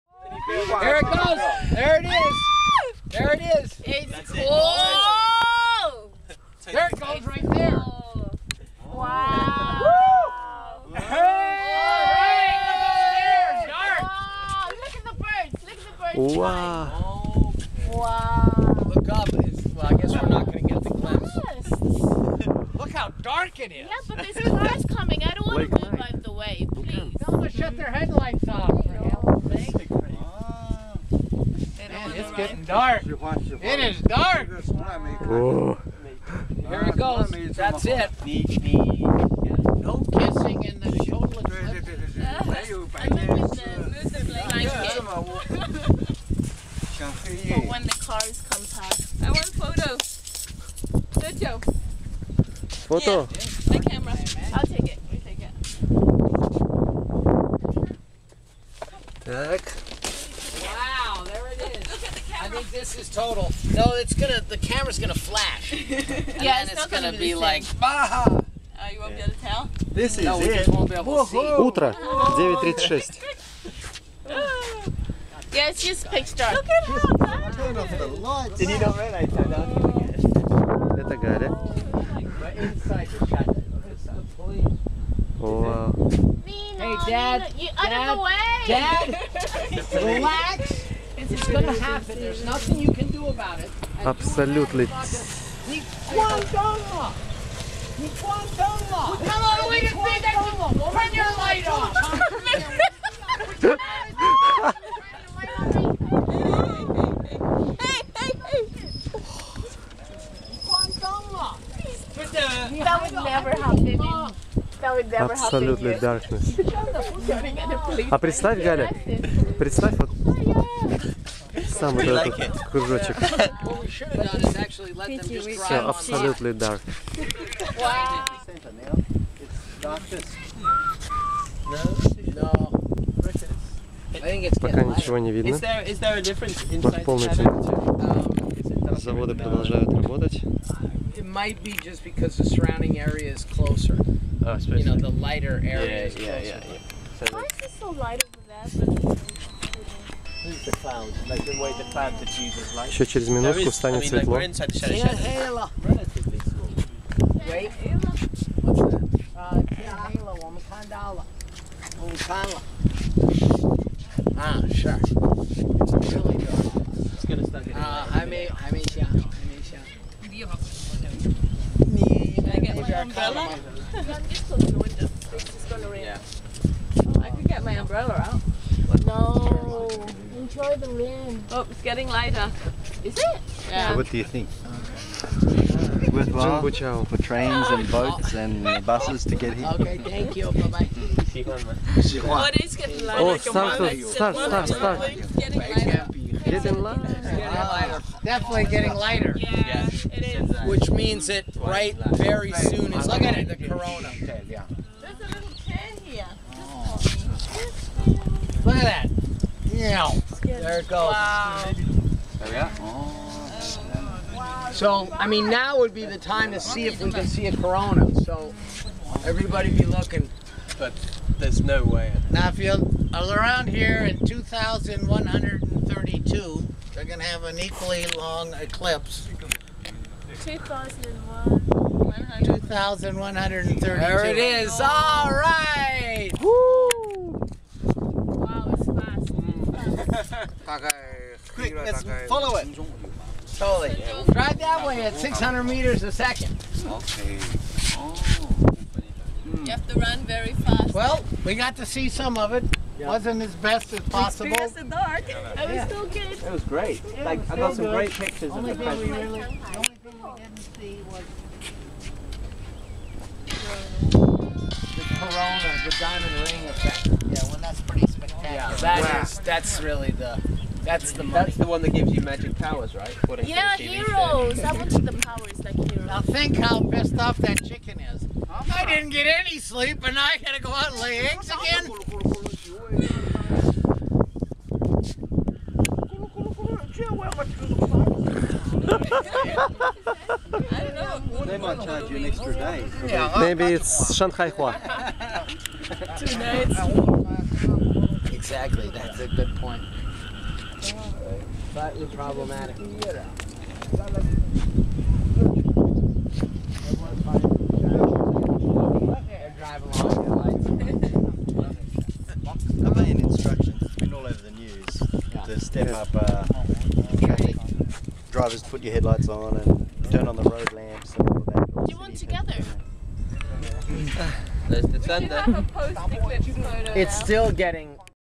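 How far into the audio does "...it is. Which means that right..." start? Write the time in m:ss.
3:19.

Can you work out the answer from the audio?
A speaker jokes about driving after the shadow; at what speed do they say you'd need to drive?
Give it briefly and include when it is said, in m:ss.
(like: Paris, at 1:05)
600 meters a second, at 4:05.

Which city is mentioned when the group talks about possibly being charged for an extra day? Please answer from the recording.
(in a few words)
Shanghai.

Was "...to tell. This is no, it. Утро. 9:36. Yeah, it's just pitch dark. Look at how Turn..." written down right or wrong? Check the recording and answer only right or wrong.
right.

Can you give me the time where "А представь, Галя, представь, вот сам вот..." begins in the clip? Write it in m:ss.
1:58.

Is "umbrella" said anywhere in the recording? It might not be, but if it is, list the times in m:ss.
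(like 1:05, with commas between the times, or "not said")
2:53, 2:57.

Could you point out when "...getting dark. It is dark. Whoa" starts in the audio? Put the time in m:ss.
0:32.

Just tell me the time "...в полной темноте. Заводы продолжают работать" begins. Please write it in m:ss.
2:16.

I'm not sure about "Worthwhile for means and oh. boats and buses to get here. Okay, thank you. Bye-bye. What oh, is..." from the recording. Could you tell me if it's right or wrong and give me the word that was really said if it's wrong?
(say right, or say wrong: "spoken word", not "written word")
wrong: "trains", not "means".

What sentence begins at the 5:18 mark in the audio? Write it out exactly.
Drivers put your headlights on and turn on the road lamps and all that.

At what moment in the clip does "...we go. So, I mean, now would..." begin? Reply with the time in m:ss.
3:32.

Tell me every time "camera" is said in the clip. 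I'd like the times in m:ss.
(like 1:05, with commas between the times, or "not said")
0:53, 1:04.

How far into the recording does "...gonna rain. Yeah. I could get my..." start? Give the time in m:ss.
2:55.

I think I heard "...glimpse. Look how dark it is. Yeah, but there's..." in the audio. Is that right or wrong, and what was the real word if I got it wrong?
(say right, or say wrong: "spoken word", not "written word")
right.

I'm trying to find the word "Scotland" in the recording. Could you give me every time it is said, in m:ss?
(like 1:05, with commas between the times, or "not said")
not said.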